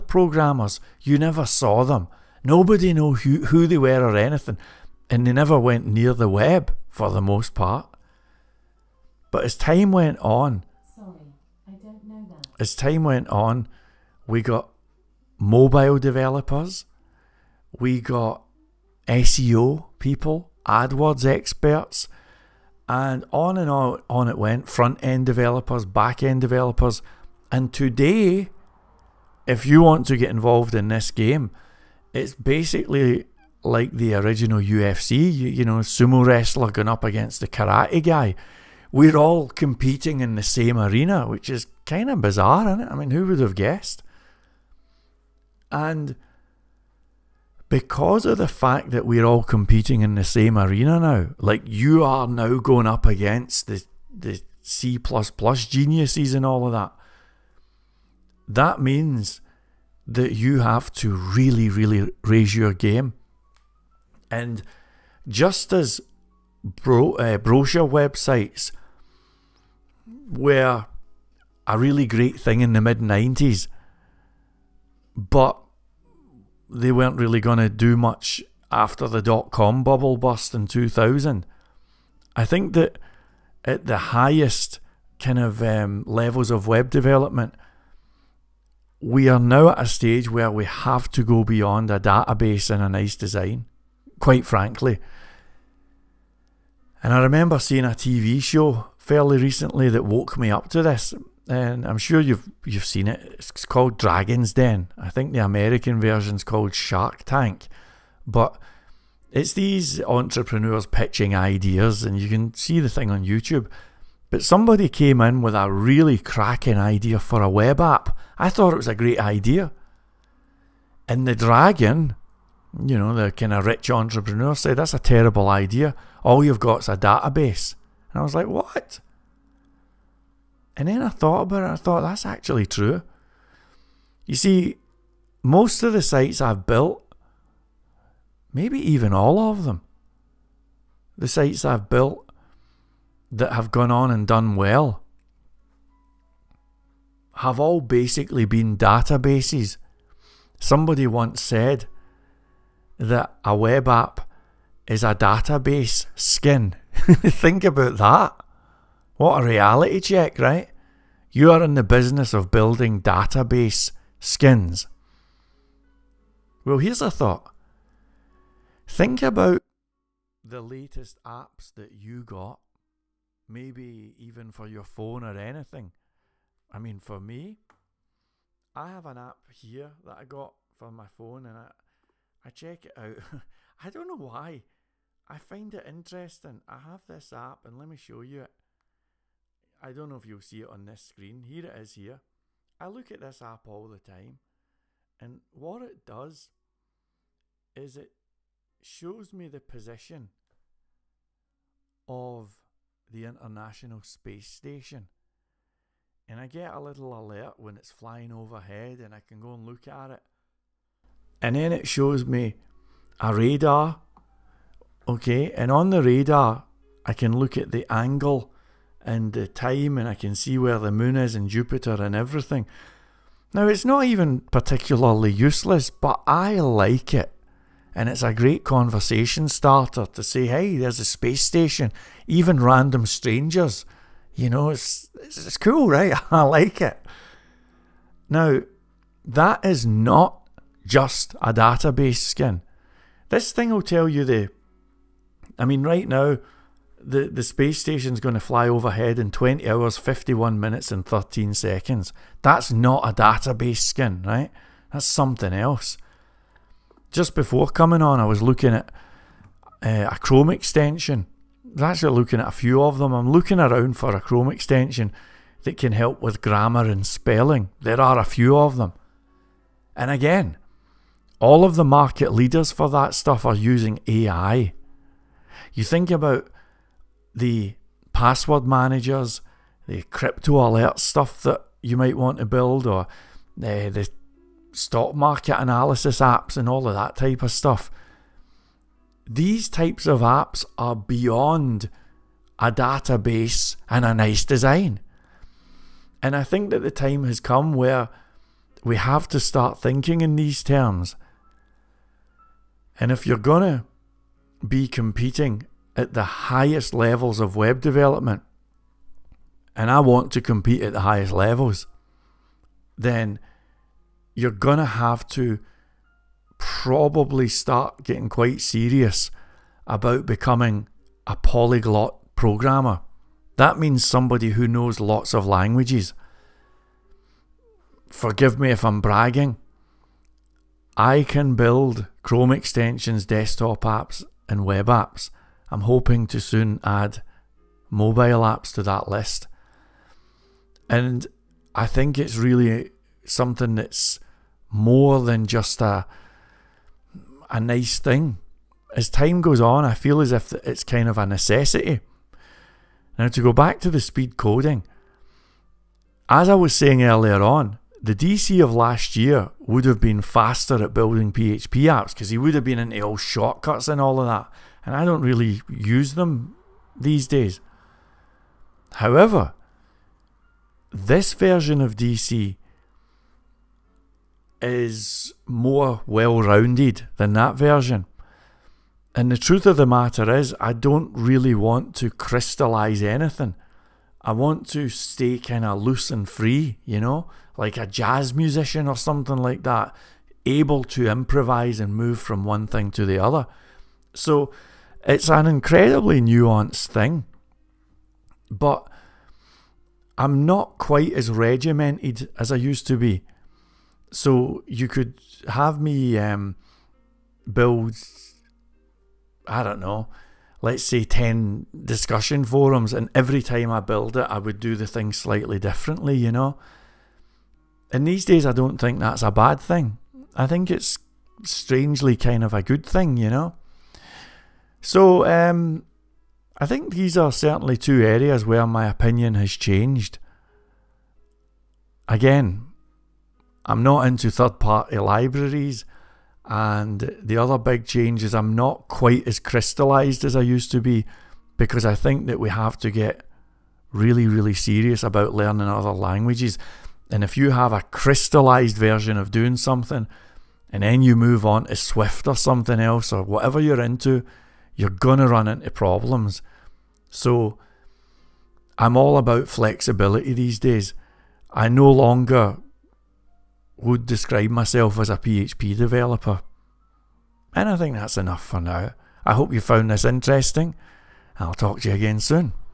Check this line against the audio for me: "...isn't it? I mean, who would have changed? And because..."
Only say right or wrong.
wrong.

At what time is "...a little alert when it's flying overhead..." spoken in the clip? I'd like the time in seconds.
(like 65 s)
206 s.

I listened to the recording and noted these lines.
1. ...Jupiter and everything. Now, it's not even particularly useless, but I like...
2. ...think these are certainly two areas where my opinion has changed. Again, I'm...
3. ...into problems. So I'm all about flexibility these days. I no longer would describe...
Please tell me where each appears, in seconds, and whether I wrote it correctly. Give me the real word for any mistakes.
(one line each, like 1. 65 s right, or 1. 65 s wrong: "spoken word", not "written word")
1. 221 s right
2. 426 s right
3. 455 s right.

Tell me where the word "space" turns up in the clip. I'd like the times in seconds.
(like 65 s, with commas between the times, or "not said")
204 s, 231 s, 247 s.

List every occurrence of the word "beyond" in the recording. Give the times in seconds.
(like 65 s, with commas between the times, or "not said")
91 s, 290 s.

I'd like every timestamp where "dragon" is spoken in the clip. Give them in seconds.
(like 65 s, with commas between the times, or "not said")
103 s, 121 s.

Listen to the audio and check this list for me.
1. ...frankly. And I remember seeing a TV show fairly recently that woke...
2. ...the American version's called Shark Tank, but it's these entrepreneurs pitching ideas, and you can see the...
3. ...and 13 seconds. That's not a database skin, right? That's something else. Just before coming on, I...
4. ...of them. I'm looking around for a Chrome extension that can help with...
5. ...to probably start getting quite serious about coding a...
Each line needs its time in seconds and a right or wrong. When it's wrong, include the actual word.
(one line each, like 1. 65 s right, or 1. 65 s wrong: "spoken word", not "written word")
1. 94 s right
2. 105 s right
3. 250 s right
4. 262 s right
5. 315 s wrong: "becoming", not "coding".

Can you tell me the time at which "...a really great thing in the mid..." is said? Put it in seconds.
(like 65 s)
71 s.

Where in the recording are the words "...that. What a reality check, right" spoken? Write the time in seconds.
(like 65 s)
157 s.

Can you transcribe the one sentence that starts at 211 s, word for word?
And then it shows me a radar.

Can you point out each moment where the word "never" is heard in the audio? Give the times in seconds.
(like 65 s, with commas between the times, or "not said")
1 s, 5 s.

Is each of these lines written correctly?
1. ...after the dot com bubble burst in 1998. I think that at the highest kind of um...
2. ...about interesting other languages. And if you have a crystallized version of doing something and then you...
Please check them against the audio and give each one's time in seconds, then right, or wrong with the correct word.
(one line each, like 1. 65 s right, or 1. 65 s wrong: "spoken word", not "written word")
1. 78 s wrong: "2000", not "1998"
2. 445 s wrong: "learning", not "interesting".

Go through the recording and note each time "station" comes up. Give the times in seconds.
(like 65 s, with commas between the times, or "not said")
204 s, 231 s, 247 s.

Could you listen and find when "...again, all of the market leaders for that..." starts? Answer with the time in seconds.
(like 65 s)
270 s.